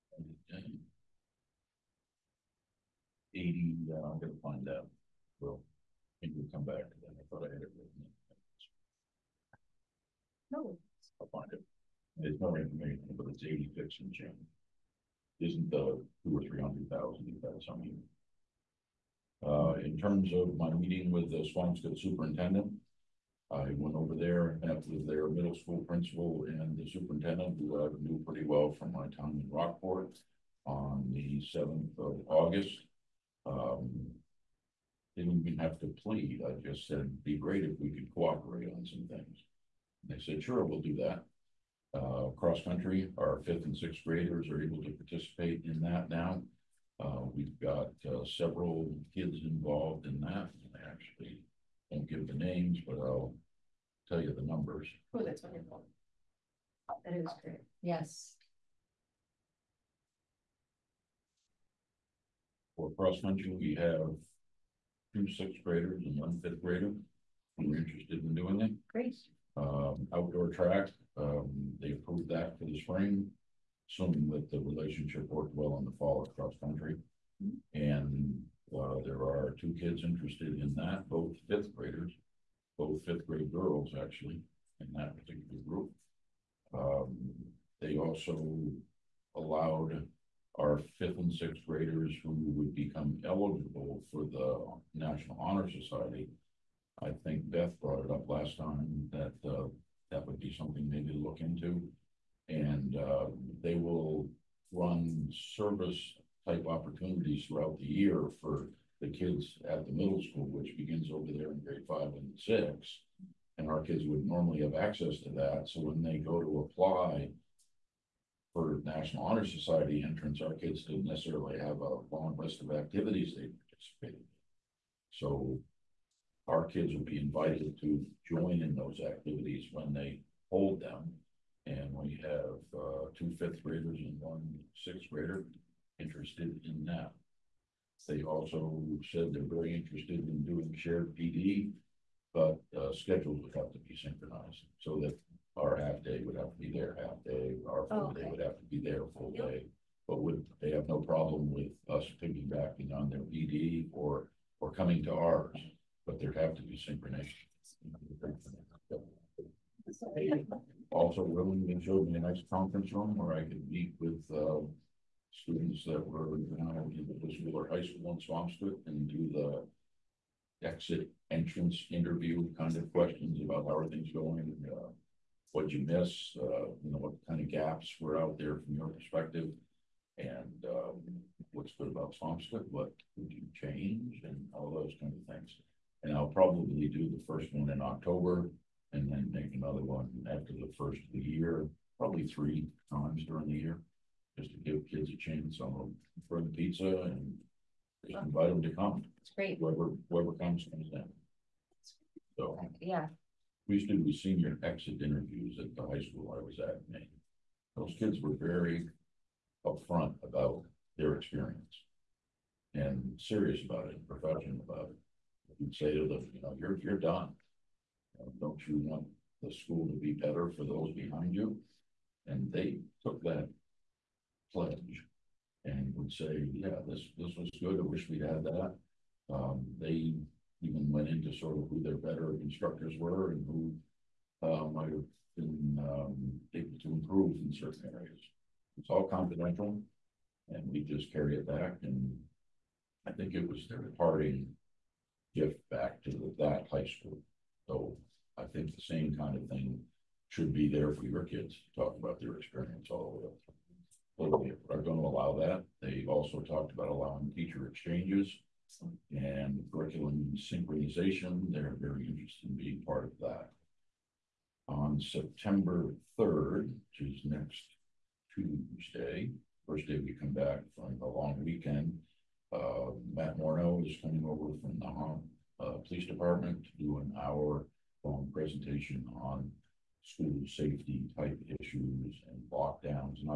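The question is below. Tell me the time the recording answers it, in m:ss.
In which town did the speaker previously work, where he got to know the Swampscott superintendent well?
0:29.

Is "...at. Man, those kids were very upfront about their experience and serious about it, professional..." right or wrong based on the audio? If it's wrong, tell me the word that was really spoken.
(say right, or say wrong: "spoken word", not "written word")
right.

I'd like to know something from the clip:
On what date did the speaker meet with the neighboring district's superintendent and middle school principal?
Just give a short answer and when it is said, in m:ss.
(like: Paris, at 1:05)
August 7, at 0:31.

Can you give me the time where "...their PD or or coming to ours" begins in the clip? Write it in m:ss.
2:33.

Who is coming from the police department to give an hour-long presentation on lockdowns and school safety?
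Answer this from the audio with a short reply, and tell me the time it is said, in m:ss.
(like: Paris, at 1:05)
Matt Morneau, at 4:33.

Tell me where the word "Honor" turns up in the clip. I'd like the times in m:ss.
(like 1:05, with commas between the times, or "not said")
1:35, 1:59.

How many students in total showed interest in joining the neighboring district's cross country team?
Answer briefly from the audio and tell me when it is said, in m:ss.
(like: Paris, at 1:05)
3, at 1:05.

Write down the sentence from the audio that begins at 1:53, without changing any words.
And our kids would normally have access to that.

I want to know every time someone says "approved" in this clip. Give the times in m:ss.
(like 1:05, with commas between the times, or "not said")
1:11.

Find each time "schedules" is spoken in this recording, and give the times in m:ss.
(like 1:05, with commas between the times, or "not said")
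2:22.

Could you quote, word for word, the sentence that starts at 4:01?
And I think it was their parting gift back to the, that high school.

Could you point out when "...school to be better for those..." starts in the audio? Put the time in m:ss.
3:39.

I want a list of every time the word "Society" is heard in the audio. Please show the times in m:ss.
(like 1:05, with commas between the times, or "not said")
1:35, 1:59.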